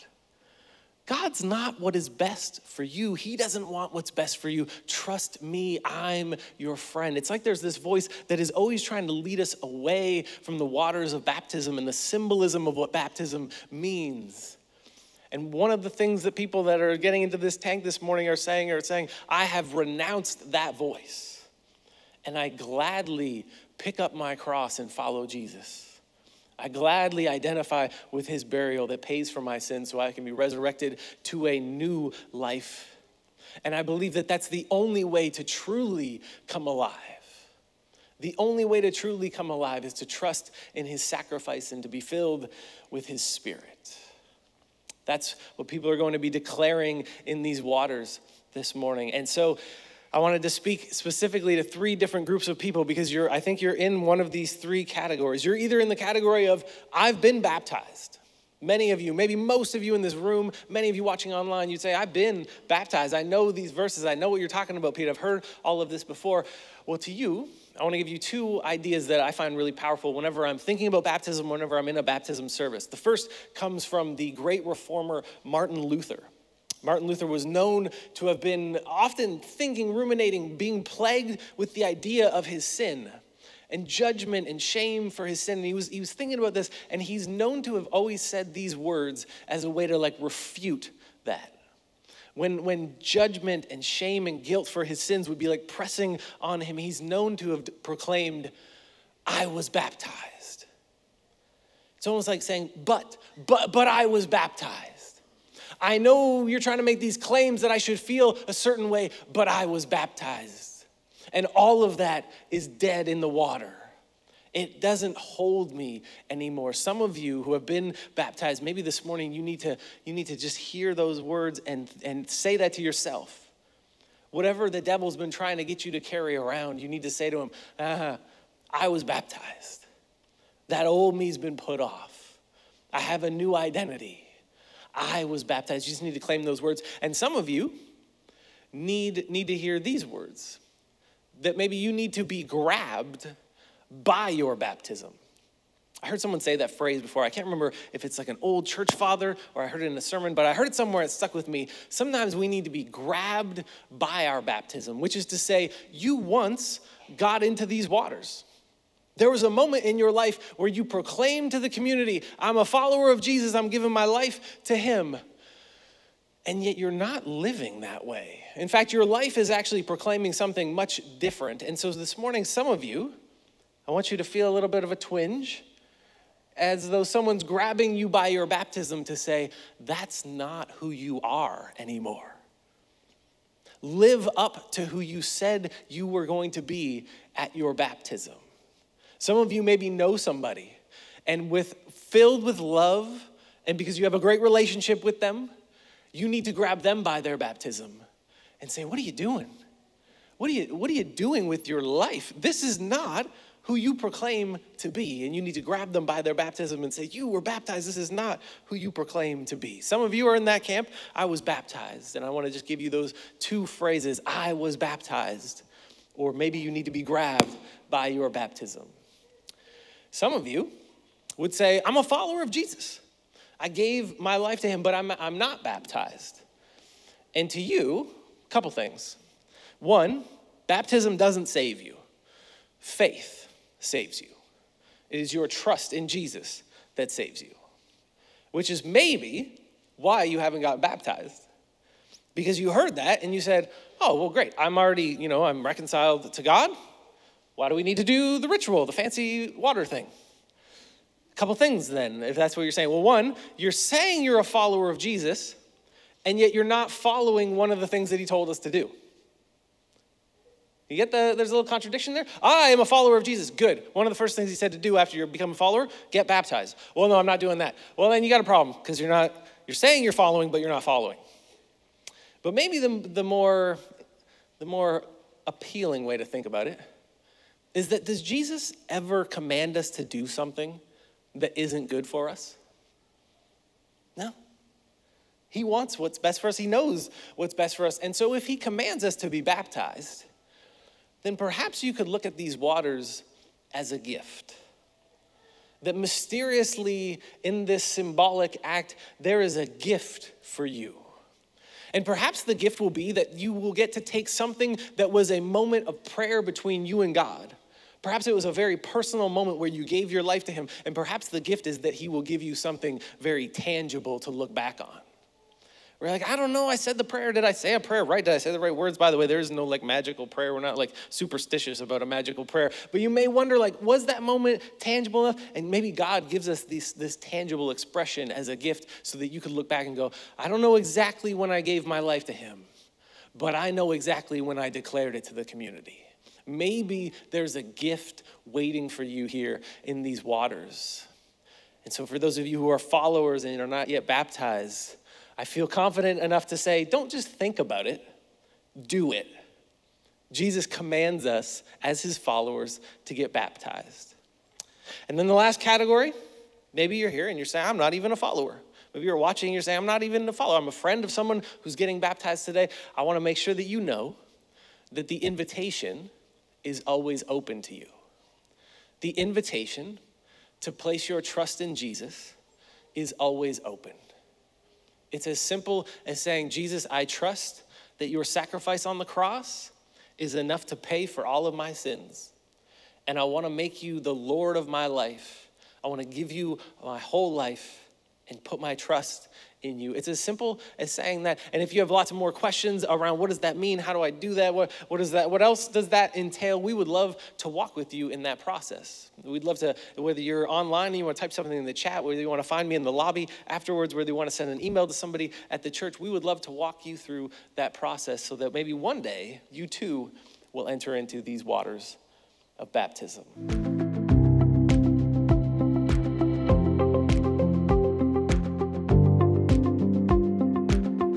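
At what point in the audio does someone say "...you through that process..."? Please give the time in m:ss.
6:46.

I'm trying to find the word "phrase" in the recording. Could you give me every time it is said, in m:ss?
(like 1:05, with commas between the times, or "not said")
2:26, 3:33.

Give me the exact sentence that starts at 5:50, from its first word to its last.
Jesus commands us as his followers to get baptized.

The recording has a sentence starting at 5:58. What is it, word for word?
Maybe you're watching and you're saying, I'm not even a follower.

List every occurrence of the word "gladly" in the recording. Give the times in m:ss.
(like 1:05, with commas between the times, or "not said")
0:22, 0:26.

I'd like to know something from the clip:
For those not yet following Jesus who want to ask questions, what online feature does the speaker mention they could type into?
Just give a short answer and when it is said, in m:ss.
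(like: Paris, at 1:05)
The chat, at 6:41.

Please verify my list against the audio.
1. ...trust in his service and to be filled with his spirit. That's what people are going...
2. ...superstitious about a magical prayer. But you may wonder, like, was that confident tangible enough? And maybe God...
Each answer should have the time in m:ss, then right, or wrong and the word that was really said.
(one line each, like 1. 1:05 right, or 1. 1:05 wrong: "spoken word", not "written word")
1. 0:40 wrong: "sacrifice", not "service"
2. 5:21 wrong: "moment", not "confident".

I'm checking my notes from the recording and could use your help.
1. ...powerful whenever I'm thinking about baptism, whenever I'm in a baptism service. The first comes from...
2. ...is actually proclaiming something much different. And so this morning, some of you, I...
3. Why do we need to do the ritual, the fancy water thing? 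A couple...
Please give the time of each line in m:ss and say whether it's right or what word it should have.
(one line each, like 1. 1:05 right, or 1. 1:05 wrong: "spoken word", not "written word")
1. 1:09 right
2. 2:49 right
3. 4:07 right.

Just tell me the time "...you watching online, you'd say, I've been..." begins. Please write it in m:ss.
1:00.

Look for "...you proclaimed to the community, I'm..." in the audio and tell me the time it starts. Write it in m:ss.
2:40.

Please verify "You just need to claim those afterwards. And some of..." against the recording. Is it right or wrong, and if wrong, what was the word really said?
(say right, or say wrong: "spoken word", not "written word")
wrong: "words", not "afterwards".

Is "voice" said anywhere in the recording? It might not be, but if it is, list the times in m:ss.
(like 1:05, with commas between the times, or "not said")
0:07, 0:20.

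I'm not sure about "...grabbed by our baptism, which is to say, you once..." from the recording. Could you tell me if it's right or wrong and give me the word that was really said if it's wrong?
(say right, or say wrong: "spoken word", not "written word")
right.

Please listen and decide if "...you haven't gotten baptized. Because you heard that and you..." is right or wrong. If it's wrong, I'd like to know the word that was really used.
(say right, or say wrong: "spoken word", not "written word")
right.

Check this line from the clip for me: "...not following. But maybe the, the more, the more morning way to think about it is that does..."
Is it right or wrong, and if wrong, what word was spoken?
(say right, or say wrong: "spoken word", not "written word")
wrong: "appealing", not "morning".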